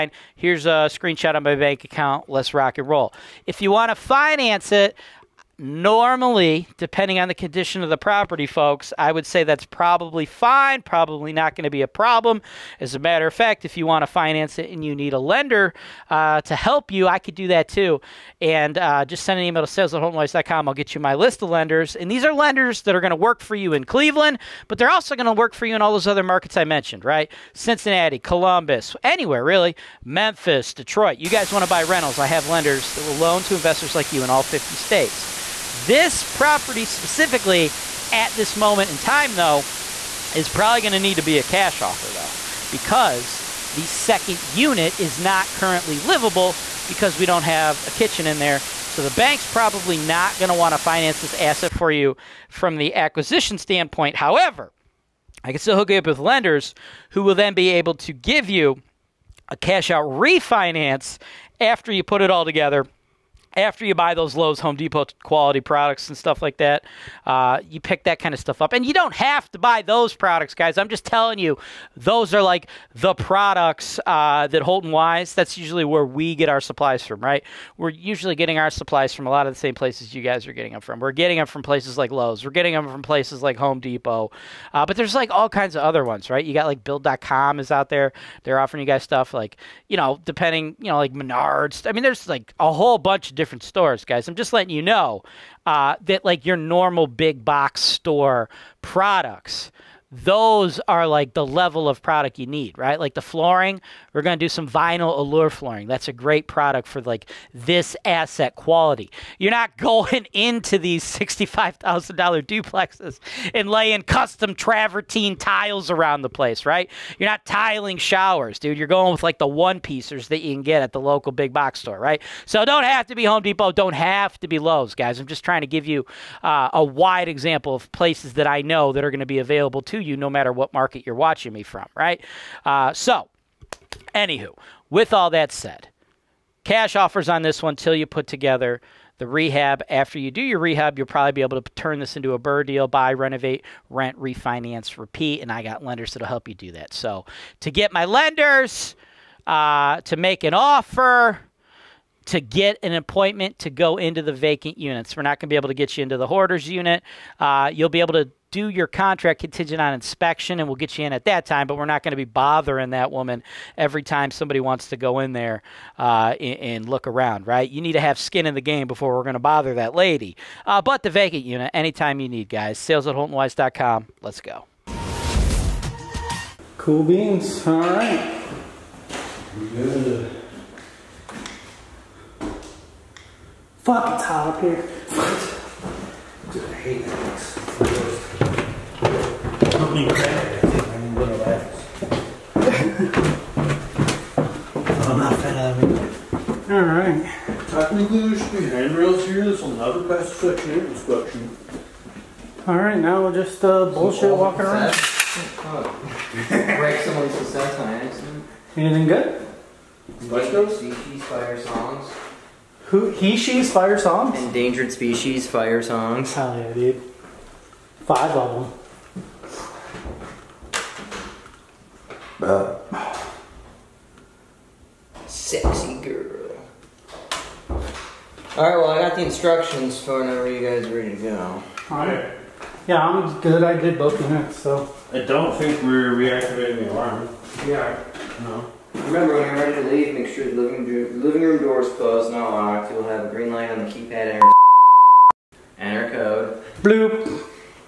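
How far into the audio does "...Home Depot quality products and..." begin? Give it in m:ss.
1:04.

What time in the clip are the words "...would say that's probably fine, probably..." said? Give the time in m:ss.
0:09.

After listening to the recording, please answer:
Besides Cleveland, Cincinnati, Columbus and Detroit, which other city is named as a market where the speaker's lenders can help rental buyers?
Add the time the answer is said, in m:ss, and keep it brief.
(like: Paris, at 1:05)
Memphis, at 0:30.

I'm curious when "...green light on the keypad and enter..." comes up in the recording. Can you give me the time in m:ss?
4:03.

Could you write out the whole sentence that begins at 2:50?
Uh, but the vacant unit, anytime you need, guys.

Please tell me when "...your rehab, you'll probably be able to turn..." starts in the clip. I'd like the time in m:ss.
2:20.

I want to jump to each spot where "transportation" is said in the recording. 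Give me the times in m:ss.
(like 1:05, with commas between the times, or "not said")
not said.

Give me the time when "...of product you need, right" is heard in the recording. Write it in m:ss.
1:41.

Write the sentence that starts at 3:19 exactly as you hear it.
This will never pass section 8 inspection.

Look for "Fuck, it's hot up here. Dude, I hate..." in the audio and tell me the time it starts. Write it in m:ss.
3:03.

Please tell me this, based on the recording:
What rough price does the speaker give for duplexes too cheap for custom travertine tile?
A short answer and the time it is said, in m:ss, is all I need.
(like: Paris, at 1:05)
$65,000, at 1:51.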